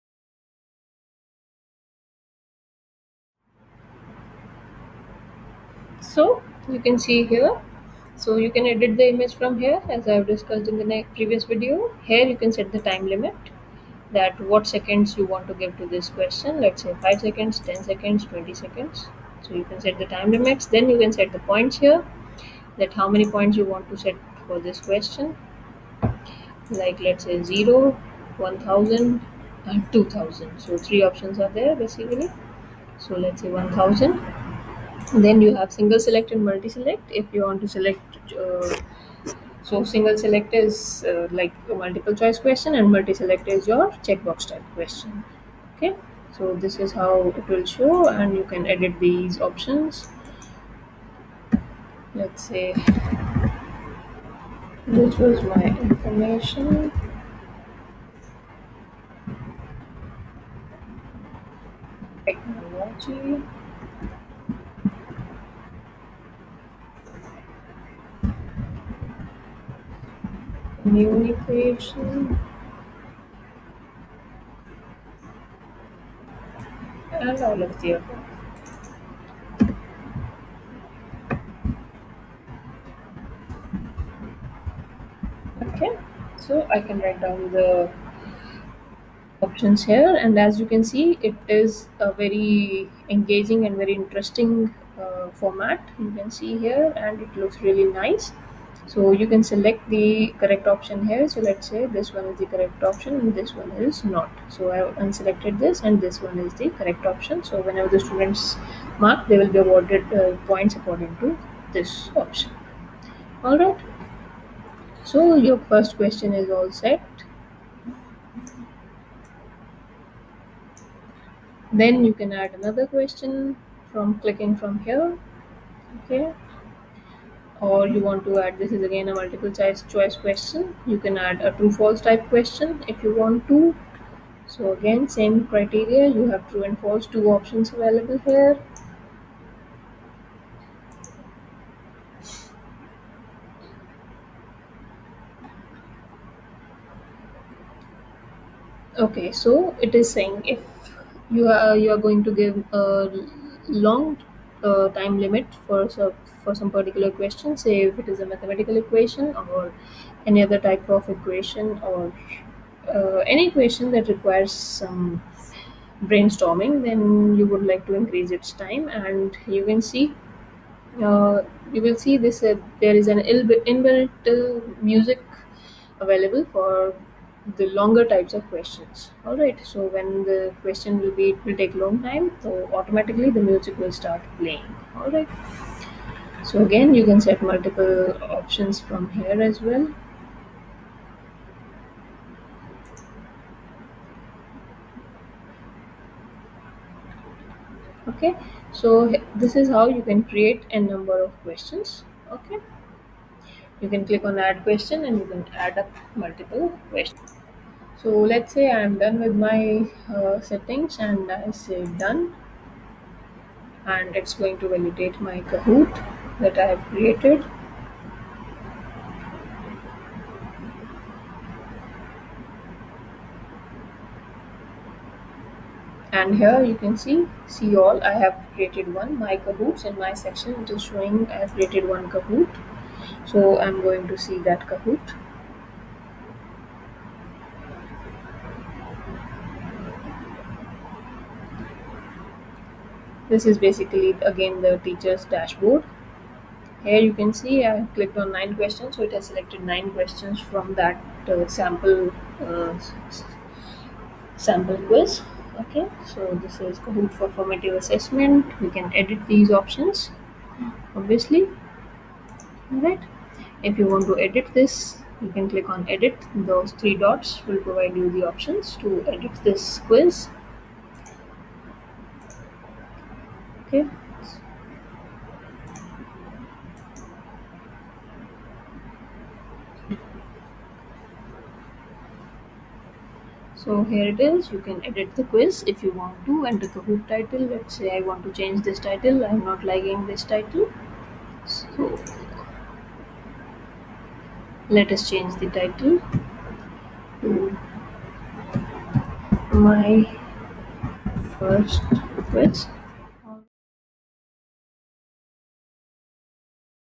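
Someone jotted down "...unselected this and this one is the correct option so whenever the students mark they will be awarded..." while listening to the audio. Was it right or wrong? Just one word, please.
right.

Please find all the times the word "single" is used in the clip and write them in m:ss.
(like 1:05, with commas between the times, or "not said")
0:35, 0:39.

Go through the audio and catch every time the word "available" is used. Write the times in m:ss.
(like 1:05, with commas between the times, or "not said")
2:17, 2:55.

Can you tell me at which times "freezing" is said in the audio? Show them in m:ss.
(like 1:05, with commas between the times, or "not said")
not said.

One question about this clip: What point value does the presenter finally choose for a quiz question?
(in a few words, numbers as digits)
1000.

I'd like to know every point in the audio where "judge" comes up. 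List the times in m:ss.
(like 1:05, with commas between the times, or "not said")
not said.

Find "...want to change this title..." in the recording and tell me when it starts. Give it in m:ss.
4:48.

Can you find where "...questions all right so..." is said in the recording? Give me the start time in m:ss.
2:58.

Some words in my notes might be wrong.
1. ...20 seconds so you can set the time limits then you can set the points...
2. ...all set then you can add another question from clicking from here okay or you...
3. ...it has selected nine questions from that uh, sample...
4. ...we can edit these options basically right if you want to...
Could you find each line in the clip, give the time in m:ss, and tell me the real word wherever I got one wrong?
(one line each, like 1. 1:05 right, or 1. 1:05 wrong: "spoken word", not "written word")
1. 0:18 right
2. 1:56 right
3. 4:09 right
4. 4:18 wrong: "obviously", not "basically".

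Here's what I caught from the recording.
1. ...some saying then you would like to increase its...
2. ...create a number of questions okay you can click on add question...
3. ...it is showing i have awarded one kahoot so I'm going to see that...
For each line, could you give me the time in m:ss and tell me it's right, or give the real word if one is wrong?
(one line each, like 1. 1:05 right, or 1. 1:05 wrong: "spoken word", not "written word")
1. 2:44 wrong: "brainstorming", not "saying"
2. 3:20 right
3. 3:50 wrong: "created", not "awarded".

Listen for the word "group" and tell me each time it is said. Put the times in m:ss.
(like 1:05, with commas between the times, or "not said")
4:46.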